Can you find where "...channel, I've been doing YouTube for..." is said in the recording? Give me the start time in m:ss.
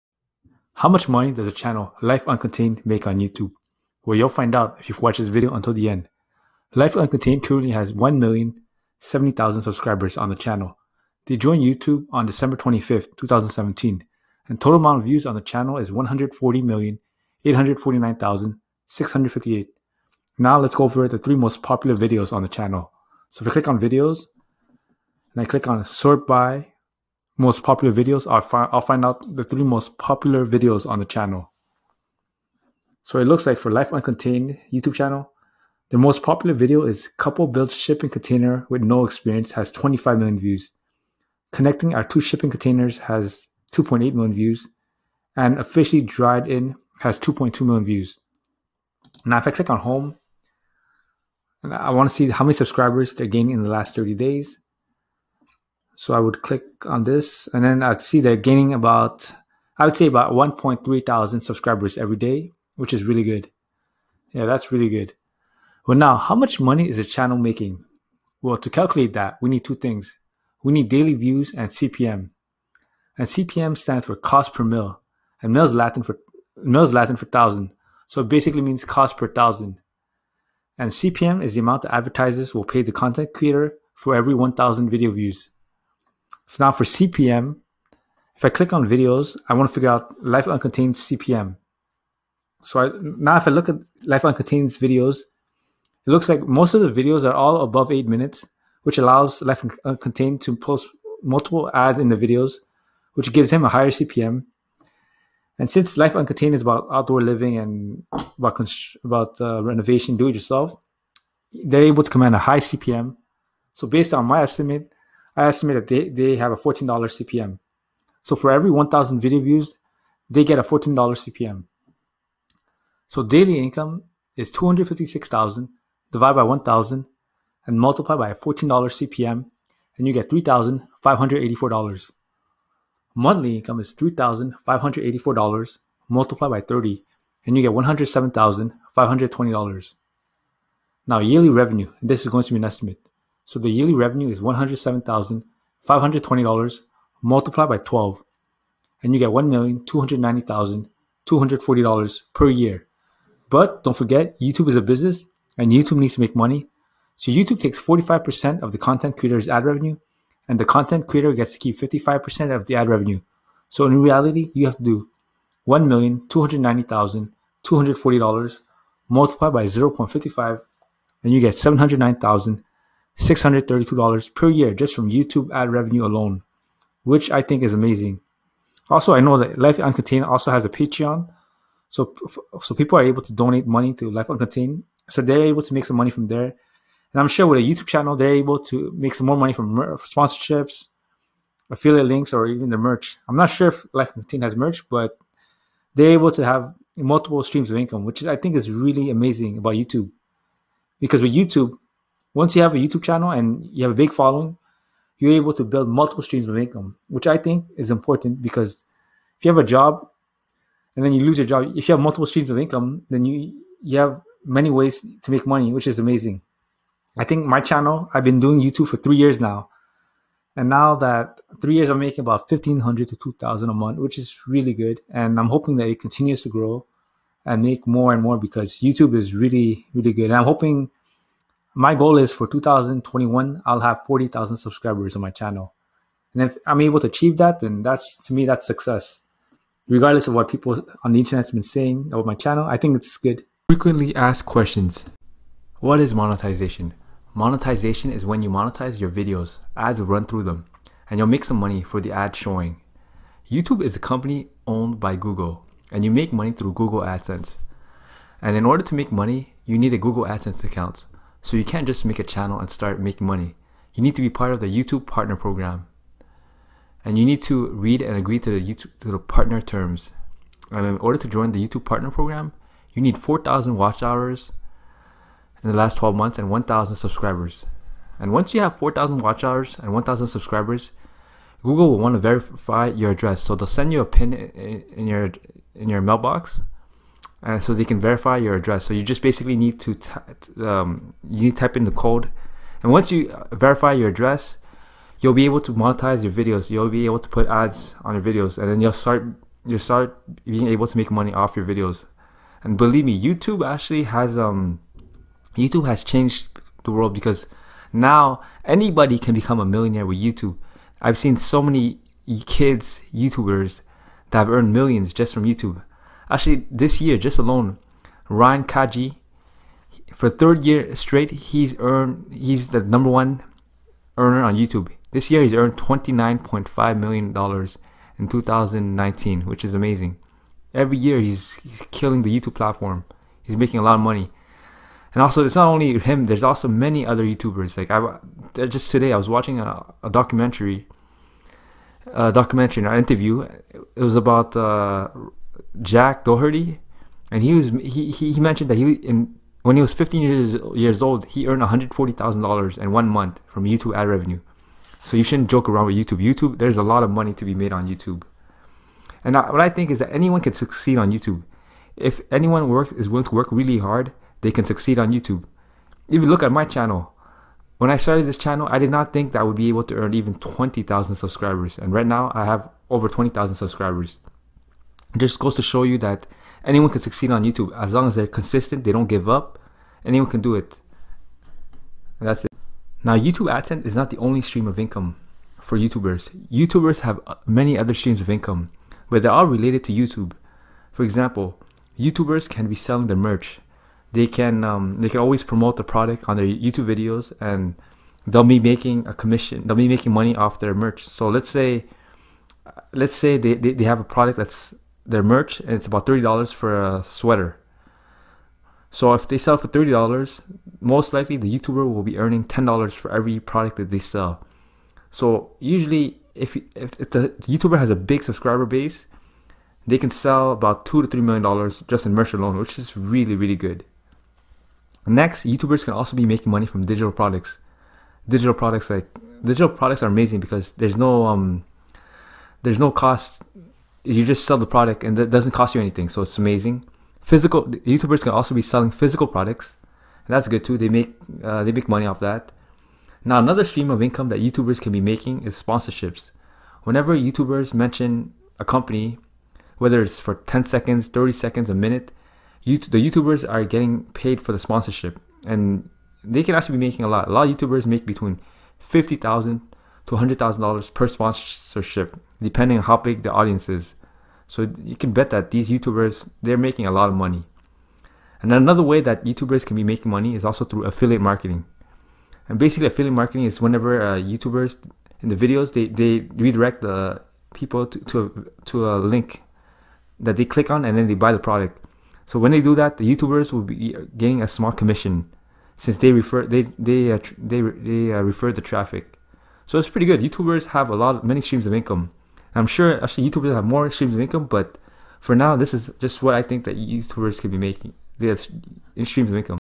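3:37.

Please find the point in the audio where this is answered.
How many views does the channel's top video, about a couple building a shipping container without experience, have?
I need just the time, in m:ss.
0:39.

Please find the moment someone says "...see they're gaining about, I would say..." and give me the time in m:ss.
0:58.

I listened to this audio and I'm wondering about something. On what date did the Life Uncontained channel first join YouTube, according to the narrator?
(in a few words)
December 25th, 2017.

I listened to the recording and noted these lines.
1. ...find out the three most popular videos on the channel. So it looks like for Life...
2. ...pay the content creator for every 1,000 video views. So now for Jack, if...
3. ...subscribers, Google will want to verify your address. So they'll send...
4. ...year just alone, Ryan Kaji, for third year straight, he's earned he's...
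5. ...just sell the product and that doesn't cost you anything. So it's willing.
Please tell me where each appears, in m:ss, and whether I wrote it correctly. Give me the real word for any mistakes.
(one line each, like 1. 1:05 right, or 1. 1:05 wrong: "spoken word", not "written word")
1. 0:28 right
2. 1:22 wrong: "CPM", not "Jack"
3. 4:40 right
4. 5:17 right
5. 7:14 wrong: "amazing", not "willing".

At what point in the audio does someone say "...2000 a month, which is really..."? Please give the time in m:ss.
3:43.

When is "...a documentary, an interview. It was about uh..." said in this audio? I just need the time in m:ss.
5:42.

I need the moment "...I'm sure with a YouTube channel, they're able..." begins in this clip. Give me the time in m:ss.
3:07.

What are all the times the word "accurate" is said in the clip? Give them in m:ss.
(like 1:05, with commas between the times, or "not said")
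not said.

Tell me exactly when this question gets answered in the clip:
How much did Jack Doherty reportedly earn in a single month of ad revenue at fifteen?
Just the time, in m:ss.
5:51.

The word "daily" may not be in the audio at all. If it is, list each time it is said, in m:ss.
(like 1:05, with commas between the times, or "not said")
1:10, 2:03.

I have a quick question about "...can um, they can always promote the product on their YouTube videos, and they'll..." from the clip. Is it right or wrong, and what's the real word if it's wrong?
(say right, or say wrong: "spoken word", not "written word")
right.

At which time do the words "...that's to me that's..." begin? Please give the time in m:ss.
3:57.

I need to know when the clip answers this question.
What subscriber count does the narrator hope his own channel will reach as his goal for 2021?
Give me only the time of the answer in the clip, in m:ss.
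3:54.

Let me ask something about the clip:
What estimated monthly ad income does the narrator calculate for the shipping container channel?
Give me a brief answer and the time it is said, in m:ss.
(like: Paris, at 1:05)
$107,520, at 2:17.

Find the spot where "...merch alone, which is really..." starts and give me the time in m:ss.
7:02.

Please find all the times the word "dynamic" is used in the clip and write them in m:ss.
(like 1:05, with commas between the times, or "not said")
not said.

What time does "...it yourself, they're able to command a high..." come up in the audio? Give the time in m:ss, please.
1:50.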